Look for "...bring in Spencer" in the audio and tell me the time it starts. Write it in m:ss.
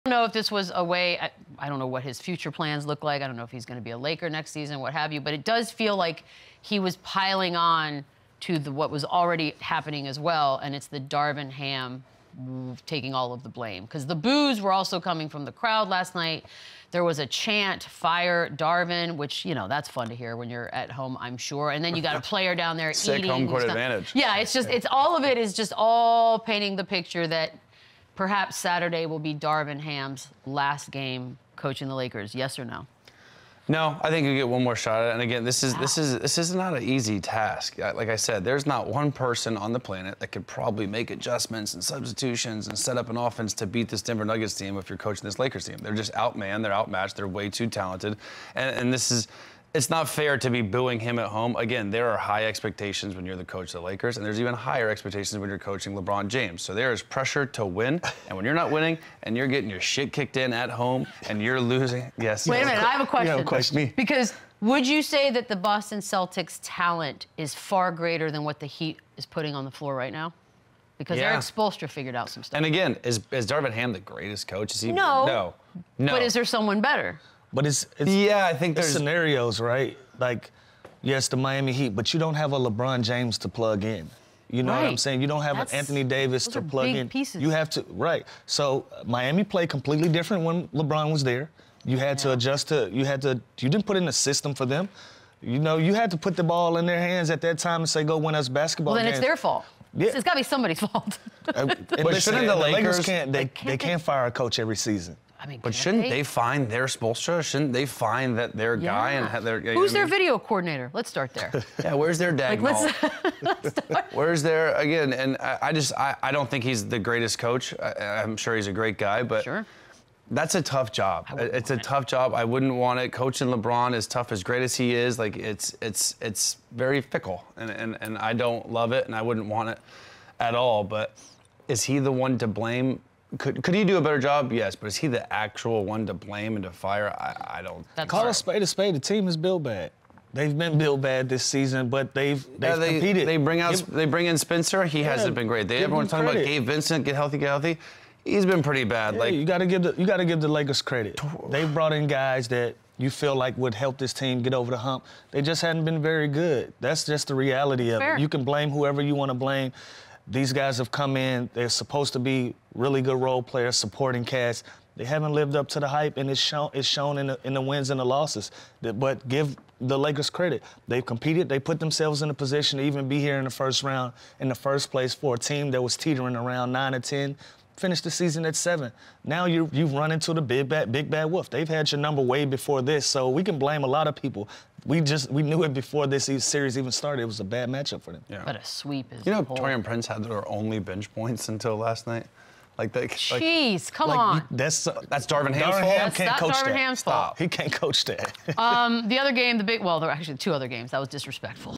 2:24.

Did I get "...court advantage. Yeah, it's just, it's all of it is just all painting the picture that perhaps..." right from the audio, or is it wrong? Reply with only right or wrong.
right.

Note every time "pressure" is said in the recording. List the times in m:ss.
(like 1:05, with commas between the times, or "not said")
0:57.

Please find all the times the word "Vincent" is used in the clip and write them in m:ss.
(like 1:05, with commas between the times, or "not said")
2:26.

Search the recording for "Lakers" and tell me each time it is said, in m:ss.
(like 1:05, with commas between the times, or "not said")
0:03, 0:31, 0:45, 0:53, 1:42, 2:30, 2:49.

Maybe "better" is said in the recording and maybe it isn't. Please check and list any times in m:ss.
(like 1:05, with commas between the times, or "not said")
1:16, 2:14.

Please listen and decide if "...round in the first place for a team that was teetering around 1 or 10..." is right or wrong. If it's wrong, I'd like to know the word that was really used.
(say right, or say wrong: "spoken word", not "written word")
wrong: "9", not "1".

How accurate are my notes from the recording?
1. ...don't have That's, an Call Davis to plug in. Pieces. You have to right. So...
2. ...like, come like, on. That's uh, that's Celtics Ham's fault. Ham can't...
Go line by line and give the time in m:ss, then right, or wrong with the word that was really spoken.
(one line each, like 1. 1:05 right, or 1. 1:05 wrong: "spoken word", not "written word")
1. 1:25 wrong: "Anthony", not "Call"
2. 3:13 wrong: "Darvin", not "Celtics".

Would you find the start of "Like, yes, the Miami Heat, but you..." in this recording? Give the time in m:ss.
1:20.